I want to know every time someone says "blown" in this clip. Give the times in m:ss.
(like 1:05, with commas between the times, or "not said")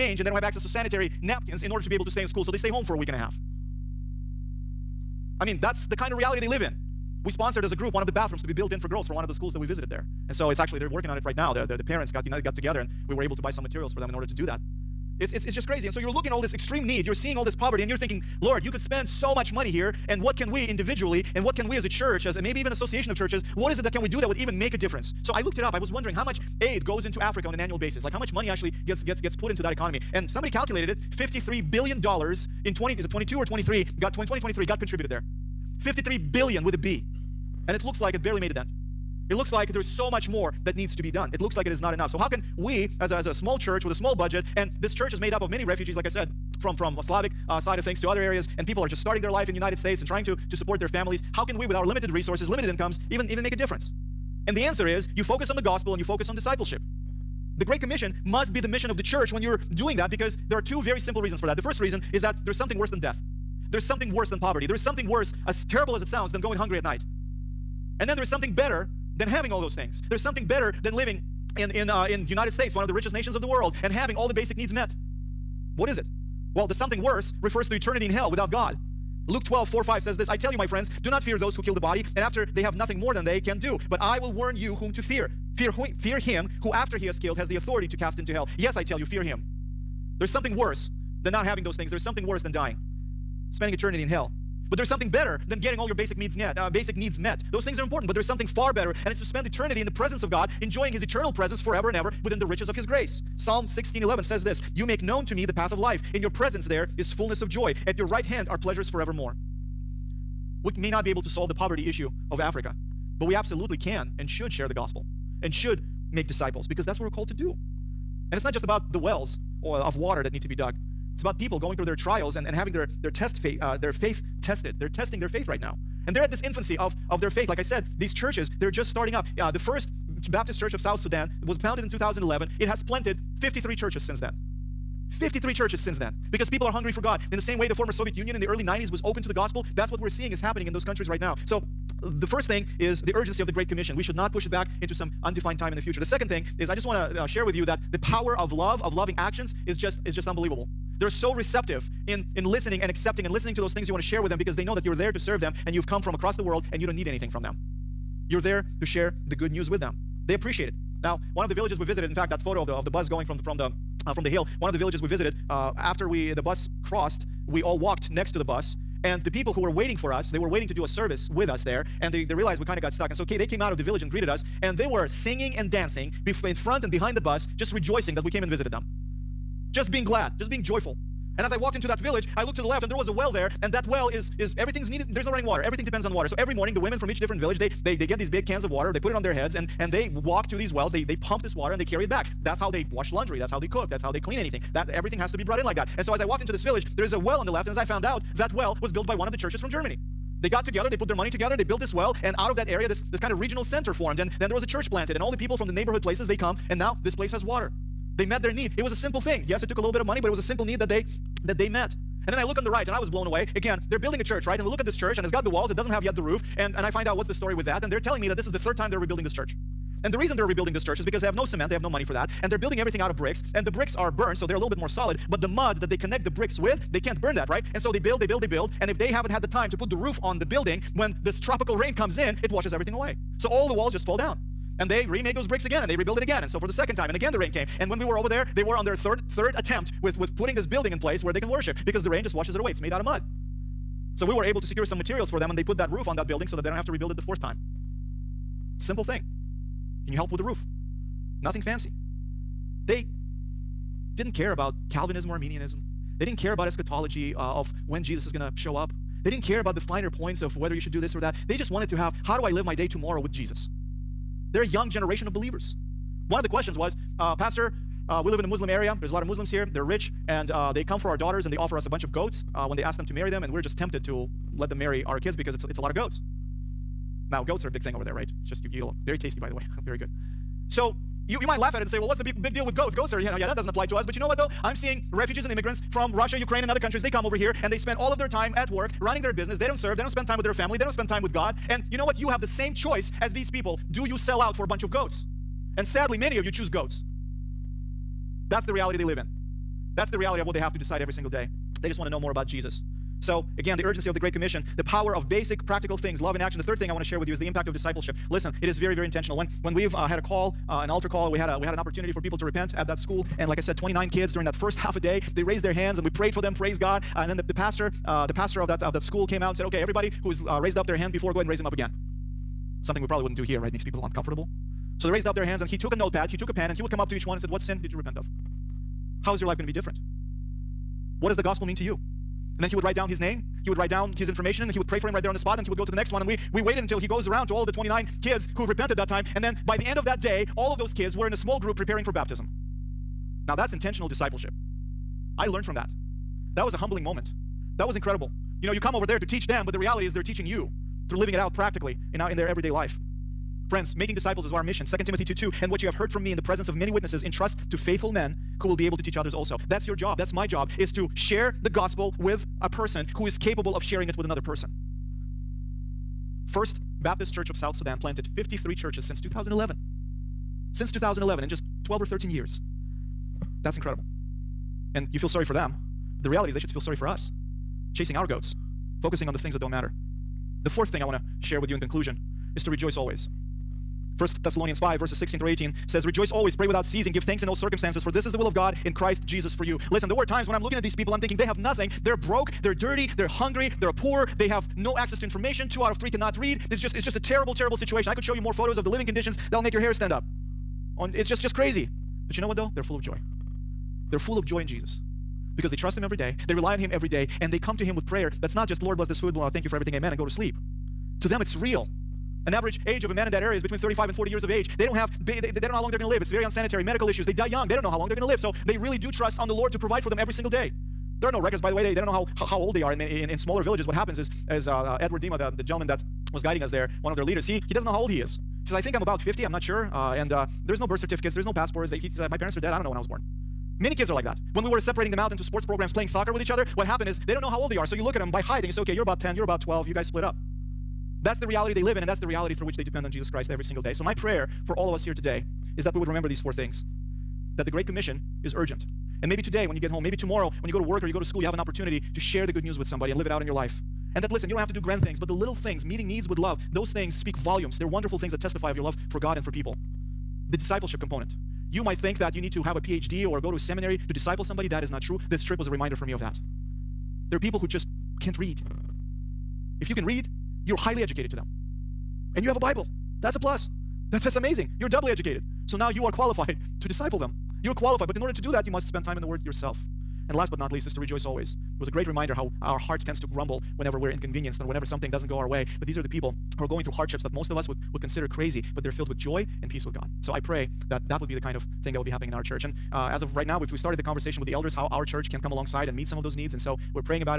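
3:33.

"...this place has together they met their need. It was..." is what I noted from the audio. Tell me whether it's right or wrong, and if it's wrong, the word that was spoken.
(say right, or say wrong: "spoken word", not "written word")
wrong: "water", not "together".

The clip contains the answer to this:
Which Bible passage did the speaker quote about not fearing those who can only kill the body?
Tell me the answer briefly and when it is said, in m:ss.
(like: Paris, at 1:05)
Luke 12:4-5, at 1:19.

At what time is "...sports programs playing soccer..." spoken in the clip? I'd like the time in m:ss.
7:15.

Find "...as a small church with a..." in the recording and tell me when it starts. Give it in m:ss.
0:43.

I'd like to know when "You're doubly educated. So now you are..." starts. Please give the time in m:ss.
7:54.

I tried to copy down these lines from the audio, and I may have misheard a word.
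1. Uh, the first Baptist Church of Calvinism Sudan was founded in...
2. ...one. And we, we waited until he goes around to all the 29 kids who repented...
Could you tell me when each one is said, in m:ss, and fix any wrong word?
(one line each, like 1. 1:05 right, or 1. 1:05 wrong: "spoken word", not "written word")
1. 2:09 wrong: "South", not "Calvinism"
2. 5:36 right.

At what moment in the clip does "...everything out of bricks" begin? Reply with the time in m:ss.
3:42.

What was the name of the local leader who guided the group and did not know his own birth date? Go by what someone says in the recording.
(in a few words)
Edward Dima.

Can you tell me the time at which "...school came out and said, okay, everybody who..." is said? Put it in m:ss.
5:19.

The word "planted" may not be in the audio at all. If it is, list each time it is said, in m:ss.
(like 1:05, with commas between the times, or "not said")
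2:12, 3:24, 6:08.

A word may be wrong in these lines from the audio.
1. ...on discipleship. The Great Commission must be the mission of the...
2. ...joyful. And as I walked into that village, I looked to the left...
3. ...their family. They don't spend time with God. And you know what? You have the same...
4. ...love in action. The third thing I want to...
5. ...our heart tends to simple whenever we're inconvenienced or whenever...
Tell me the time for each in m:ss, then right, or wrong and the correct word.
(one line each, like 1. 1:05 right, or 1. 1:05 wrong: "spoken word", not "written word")
1. 0:56 right
2. 3:00 right
3. 4:50 right
4. 5:06 right
5. 8:02 wrong: "grumble", not "simple".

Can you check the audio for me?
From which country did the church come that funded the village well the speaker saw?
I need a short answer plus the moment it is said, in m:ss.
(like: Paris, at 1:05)
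Germany, at 3:19.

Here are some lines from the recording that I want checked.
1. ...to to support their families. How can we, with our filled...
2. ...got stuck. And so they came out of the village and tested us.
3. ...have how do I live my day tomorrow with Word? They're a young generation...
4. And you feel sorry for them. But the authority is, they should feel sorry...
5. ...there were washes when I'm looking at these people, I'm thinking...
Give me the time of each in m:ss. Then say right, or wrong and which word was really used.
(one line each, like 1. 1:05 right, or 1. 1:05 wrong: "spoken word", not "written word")
1. 0:50 wrong: "limited", not "filled"
2. 2:52 wrong: "greeted", not "tested"
3. 4:21 wrong: "Jesus", not "Word"
4. 6:14 wrong: "reality", not "authority"
5. 6:30 wrong: "times", not "washes".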